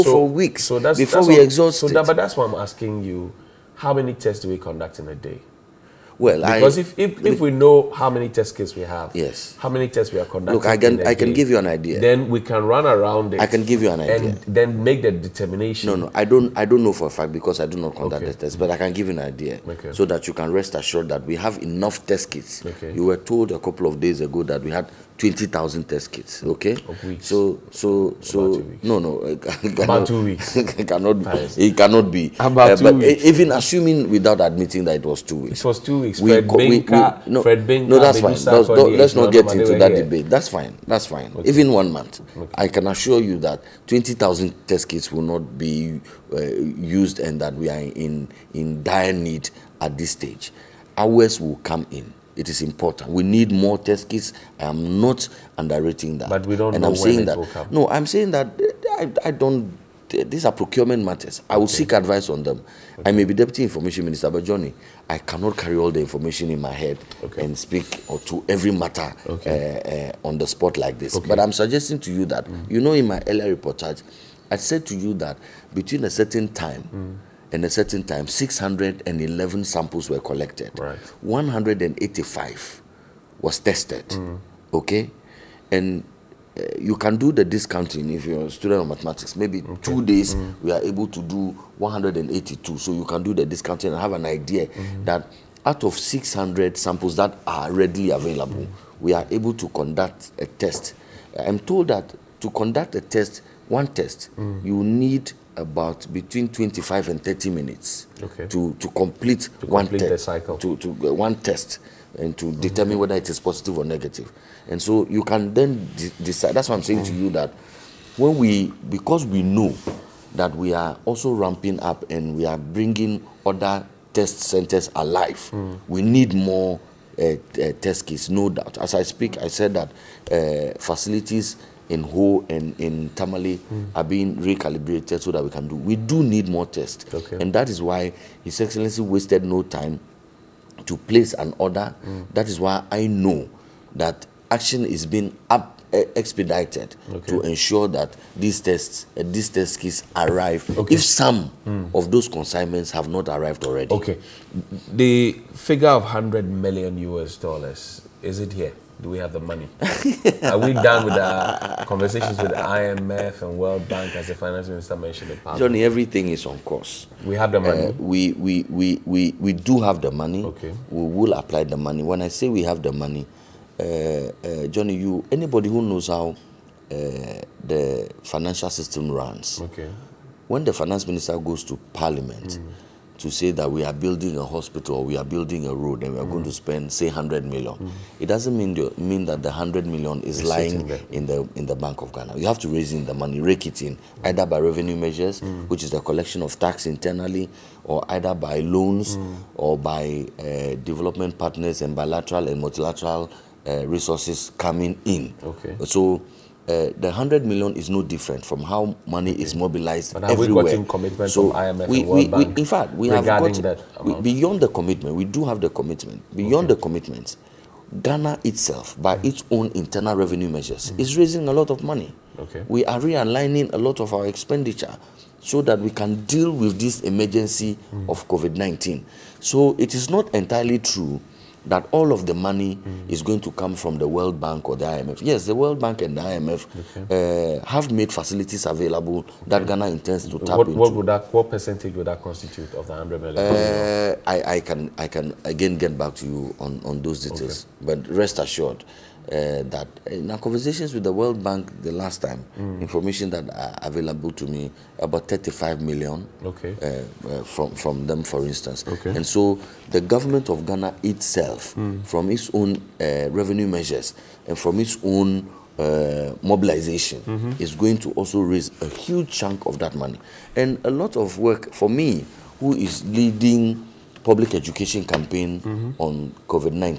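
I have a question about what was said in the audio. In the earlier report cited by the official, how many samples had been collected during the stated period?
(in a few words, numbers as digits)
611.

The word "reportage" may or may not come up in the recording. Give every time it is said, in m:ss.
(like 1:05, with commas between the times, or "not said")
1:13.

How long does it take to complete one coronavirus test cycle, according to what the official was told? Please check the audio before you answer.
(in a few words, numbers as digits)
25 to 30 minutes.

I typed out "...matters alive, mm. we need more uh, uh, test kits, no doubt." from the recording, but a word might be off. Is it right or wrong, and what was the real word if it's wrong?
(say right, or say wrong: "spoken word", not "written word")
wrong: "centers", not "matters".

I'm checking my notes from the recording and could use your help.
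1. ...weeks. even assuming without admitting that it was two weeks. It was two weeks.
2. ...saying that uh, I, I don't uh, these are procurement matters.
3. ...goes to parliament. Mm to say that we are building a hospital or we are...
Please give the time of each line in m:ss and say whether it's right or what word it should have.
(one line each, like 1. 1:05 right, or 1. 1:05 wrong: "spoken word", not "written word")
1. 0:32 right
2. 0:58 right
3. 3:01 right.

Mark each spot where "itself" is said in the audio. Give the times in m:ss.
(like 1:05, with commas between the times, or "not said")
3:38, 4:21.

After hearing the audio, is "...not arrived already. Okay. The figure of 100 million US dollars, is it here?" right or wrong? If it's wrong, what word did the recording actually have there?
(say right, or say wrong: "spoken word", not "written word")
right.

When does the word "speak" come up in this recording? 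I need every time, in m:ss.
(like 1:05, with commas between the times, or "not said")
1:07, 2:09.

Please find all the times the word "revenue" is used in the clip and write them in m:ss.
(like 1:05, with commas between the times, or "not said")
3:14, 3:40, 4:23.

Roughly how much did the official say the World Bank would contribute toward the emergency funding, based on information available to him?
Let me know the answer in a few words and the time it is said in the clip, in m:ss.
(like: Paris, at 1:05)
35 million, at 4:15.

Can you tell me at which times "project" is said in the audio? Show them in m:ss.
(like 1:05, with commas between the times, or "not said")
not said.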